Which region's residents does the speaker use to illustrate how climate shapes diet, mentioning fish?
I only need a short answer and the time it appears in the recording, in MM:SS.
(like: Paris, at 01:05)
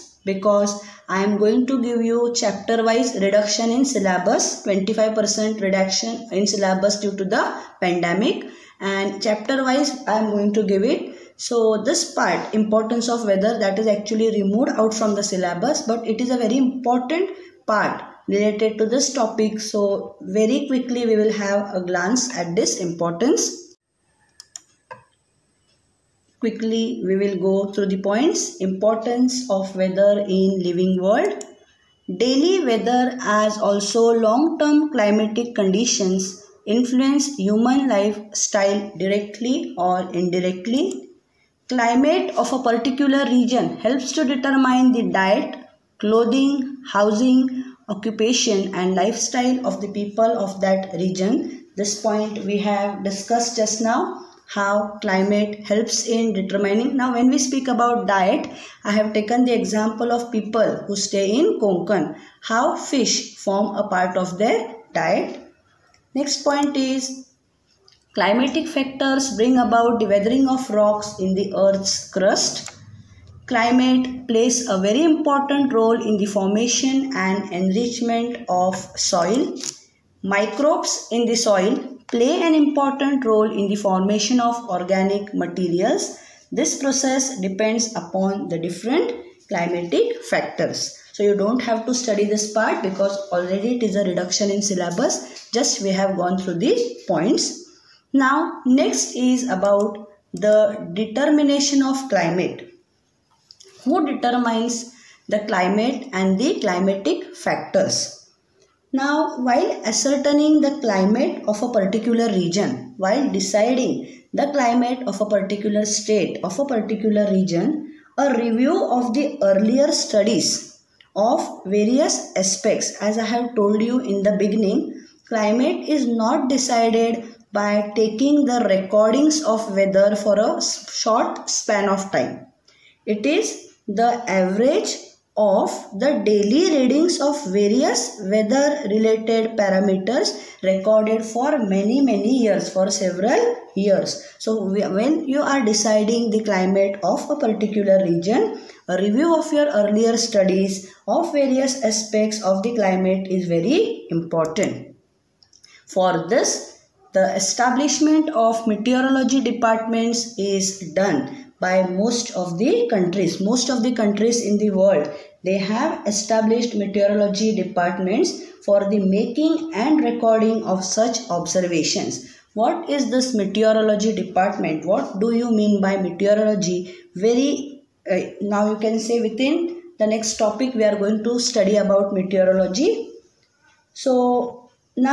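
Konkan, at 01:01.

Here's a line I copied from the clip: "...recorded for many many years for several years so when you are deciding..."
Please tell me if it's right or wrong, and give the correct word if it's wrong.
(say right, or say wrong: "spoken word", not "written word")
right.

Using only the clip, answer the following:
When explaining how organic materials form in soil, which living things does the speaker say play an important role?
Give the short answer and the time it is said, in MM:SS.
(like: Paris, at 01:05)
Microbes, at 01:20.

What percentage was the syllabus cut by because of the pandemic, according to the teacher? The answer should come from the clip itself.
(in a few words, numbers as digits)
25%.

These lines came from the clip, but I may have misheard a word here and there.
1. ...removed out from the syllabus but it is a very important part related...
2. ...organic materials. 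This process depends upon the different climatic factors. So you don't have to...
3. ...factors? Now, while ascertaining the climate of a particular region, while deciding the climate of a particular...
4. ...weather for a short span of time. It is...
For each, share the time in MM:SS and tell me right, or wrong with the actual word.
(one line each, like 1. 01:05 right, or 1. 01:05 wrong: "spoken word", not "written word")
1. 00:14 right
2. 01:24 right
3. 01:47 right
4. 02:09 right.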